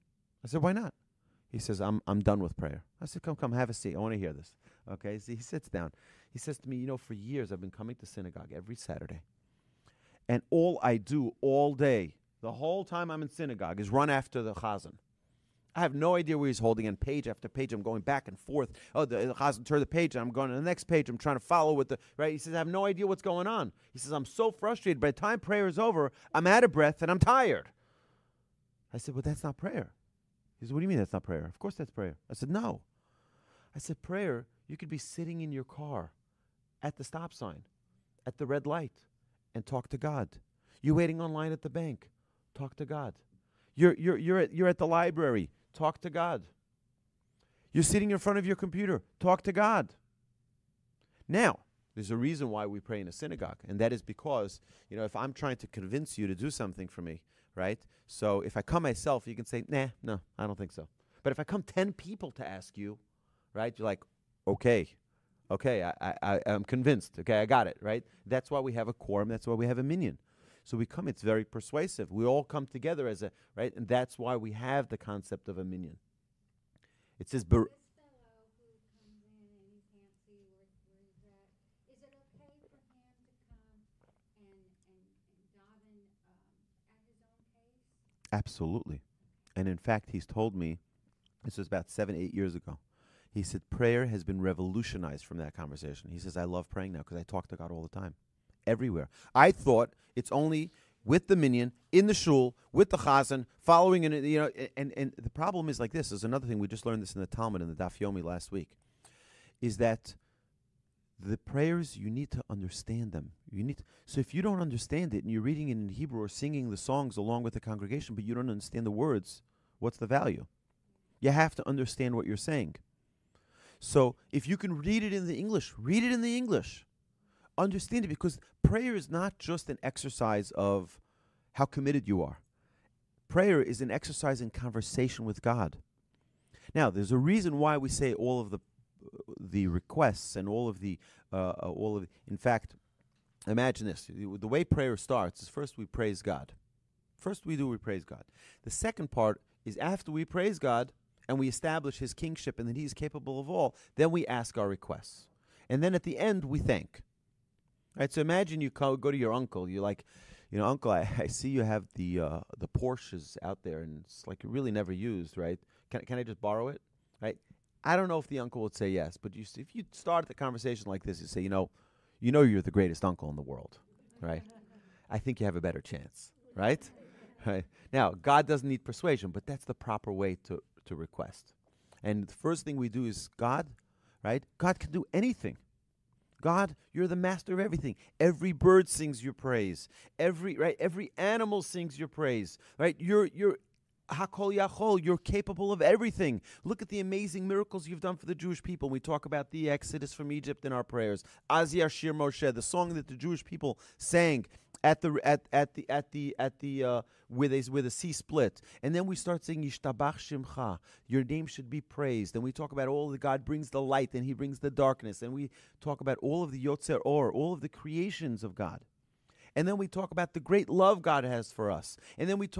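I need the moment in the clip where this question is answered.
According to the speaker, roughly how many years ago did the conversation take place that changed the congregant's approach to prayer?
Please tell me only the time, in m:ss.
1:31.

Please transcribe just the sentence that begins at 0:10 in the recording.
And all I do all day, the whole time I'm in synagogue, is run after the chazan.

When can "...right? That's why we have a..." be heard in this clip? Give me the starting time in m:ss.
1:07.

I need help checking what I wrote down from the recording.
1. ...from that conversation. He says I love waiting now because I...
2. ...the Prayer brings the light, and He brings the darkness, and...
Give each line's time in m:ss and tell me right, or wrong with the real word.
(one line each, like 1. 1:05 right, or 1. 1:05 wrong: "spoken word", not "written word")
1. 1:35 wrong: "praying", not "waiting"
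2. 3:33 wrong: "God", not "Prayer".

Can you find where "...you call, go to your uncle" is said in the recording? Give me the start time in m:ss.
2:38.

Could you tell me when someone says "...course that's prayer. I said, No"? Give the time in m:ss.
0:31.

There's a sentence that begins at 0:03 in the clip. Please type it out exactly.
I said, come, come, have a seat.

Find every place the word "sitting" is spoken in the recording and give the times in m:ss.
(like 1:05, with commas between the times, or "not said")
0:34, 0:47.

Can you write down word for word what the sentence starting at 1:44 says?
And and the problem is like this.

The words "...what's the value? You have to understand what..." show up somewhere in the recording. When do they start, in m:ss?
1:59.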